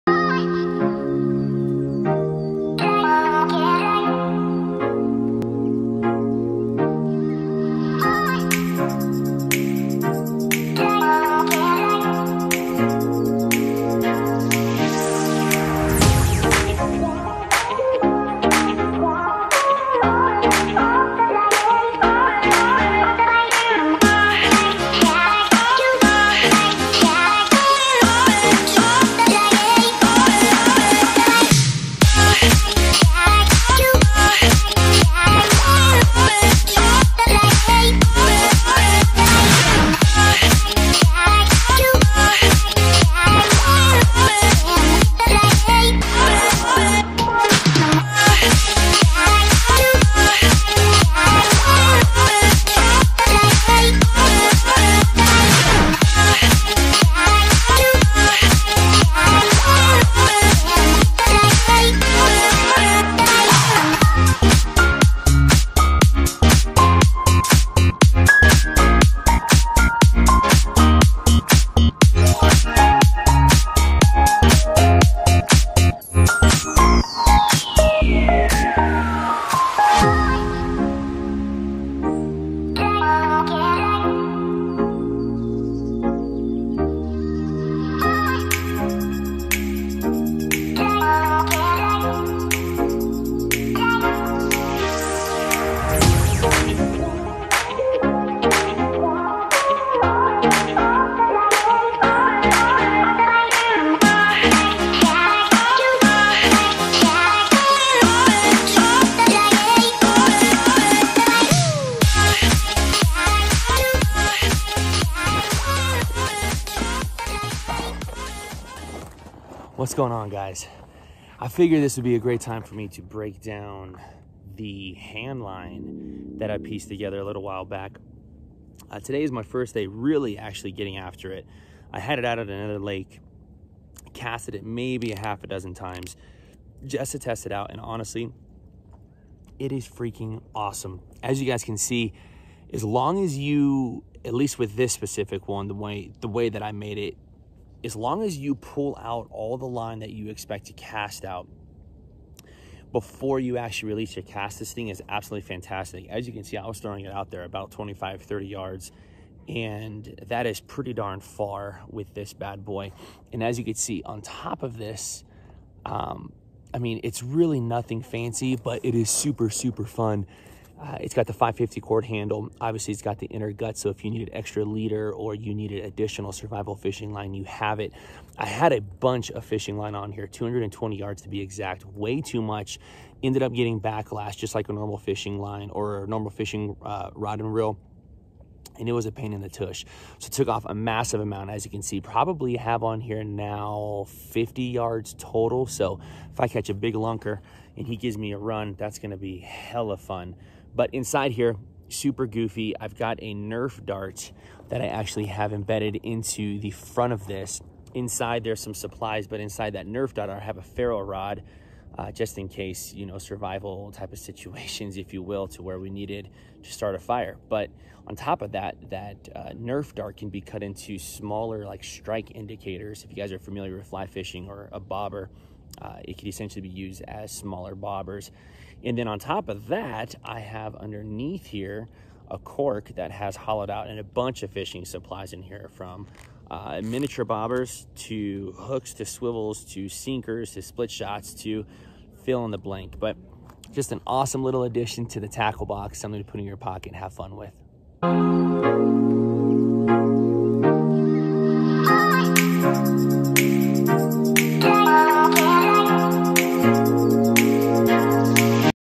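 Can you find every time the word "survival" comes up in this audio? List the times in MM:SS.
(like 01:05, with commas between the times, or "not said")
02:56, 03:33.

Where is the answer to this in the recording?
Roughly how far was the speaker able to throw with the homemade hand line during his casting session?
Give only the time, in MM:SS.
02:37.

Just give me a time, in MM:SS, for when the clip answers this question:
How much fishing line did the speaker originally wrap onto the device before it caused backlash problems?
03:00.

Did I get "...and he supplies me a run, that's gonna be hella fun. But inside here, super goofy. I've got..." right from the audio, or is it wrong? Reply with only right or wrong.
wrong.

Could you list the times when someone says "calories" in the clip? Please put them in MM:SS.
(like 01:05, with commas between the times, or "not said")
not said.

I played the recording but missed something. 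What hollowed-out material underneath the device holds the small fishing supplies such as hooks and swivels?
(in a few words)
Cork.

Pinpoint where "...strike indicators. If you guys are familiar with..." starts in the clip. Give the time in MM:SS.
03:41.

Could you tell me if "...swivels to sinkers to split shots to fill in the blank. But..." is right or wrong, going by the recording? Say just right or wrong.
right.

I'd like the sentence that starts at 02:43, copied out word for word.
And as you can see, on top of this, um, I mean, it's really nothing fancy, but it is super, super fun.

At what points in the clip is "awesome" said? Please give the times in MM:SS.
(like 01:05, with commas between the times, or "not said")
02:20, 04:04.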